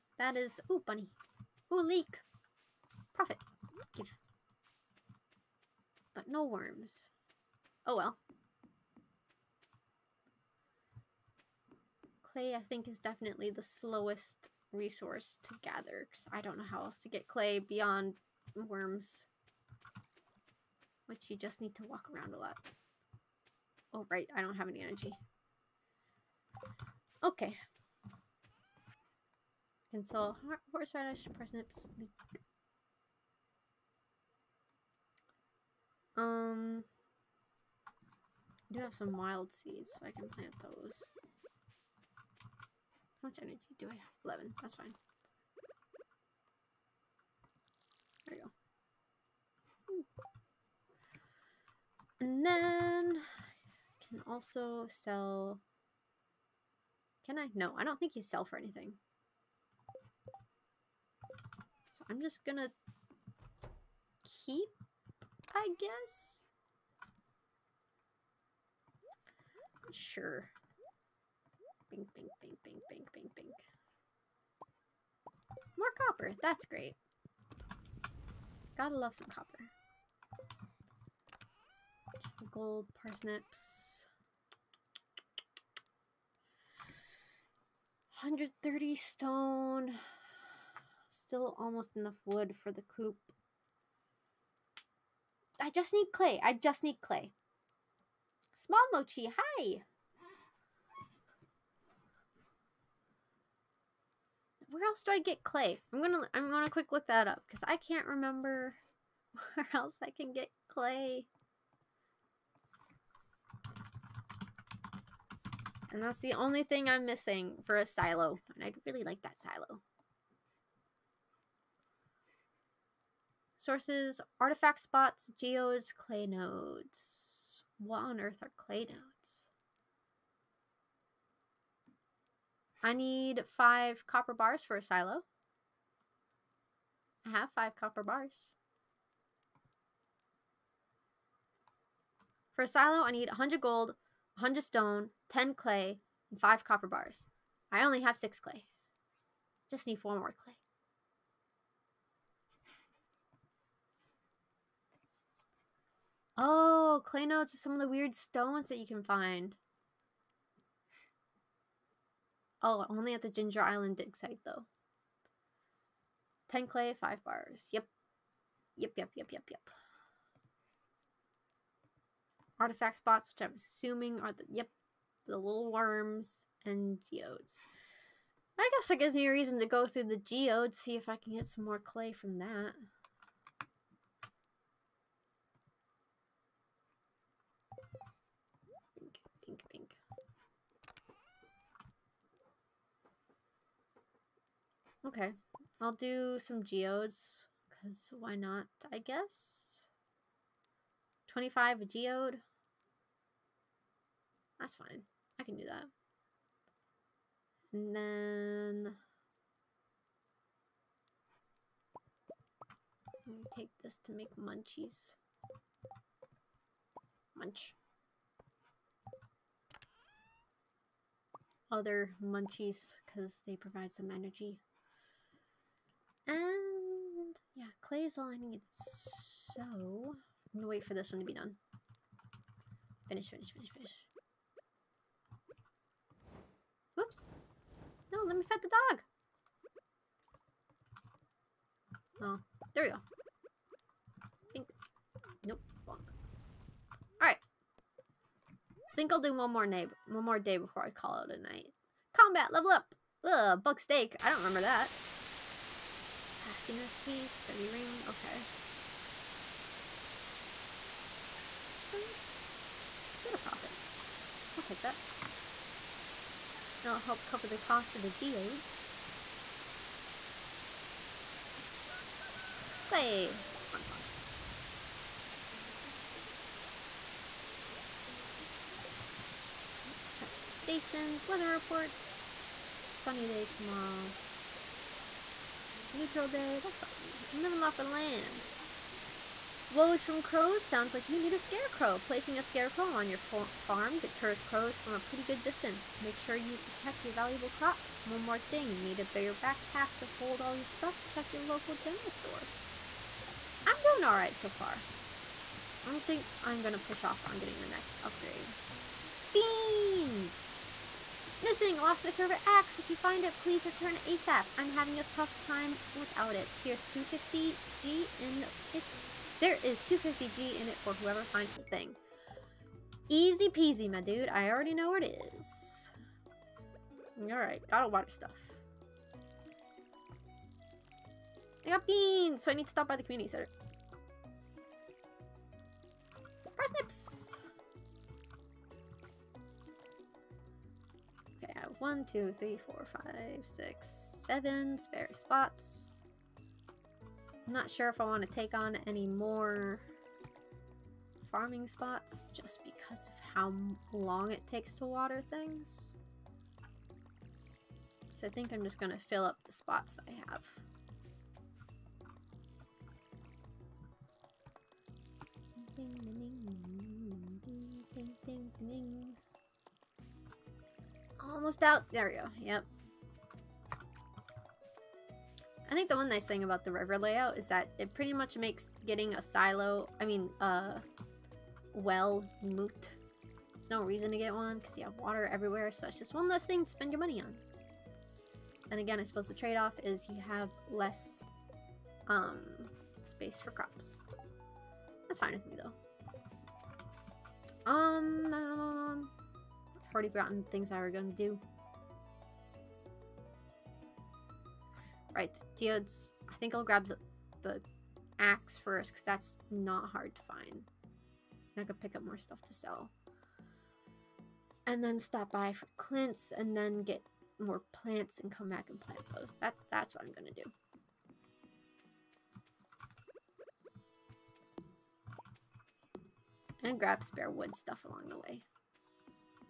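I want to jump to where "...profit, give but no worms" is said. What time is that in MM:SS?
00:03.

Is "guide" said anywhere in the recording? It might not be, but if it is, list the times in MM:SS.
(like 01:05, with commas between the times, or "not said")
not said.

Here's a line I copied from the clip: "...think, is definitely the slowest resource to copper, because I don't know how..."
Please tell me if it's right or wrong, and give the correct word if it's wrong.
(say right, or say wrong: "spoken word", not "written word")
wrong: "gather", not "copper".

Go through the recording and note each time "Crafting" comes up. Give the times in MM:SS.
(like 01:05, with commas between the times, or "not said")
04:16.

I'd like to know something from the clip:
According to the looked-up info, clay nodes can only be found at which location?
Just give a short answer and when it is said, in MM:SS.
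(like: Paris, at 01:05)
Ginger Island dig site, at 02:43.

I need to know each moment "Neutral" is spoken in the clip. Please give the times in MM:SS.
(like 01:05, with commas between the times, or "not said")
04:45.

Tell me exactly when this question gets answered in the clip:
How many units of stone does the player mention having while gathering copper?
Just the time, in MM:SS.
01:28.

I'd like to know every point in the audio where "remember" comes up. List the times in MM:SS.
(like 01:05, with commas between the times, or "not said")
01:48, 04:14.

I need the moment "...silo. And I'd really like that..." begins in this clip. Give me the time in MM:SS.
01:57.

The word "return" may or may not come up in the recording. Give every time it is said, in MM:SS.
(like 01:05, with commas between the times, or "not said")
05:13.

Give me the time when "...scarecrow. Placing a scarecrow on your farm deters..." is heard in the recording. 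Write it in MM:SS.
04:51.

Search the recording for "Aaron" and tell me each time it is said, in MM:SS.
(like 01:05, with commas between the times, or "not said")
not said.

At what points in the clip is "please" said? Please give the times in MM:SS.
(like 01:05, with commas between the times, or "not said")
05:13.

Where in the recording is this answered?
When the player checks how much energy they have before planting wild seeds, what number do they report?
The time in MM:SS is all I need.
00:44.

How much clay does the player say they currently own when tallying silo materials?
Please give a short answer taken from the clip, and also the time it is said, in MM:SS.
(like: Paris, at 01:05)
6, at 02:28.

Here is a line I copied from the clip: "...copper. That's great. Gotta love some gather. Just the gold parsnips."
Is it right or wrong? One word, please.
wrong.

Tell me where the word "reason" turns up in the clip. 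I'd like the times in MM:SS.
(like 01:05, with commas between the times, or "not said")
02:59, 06:23.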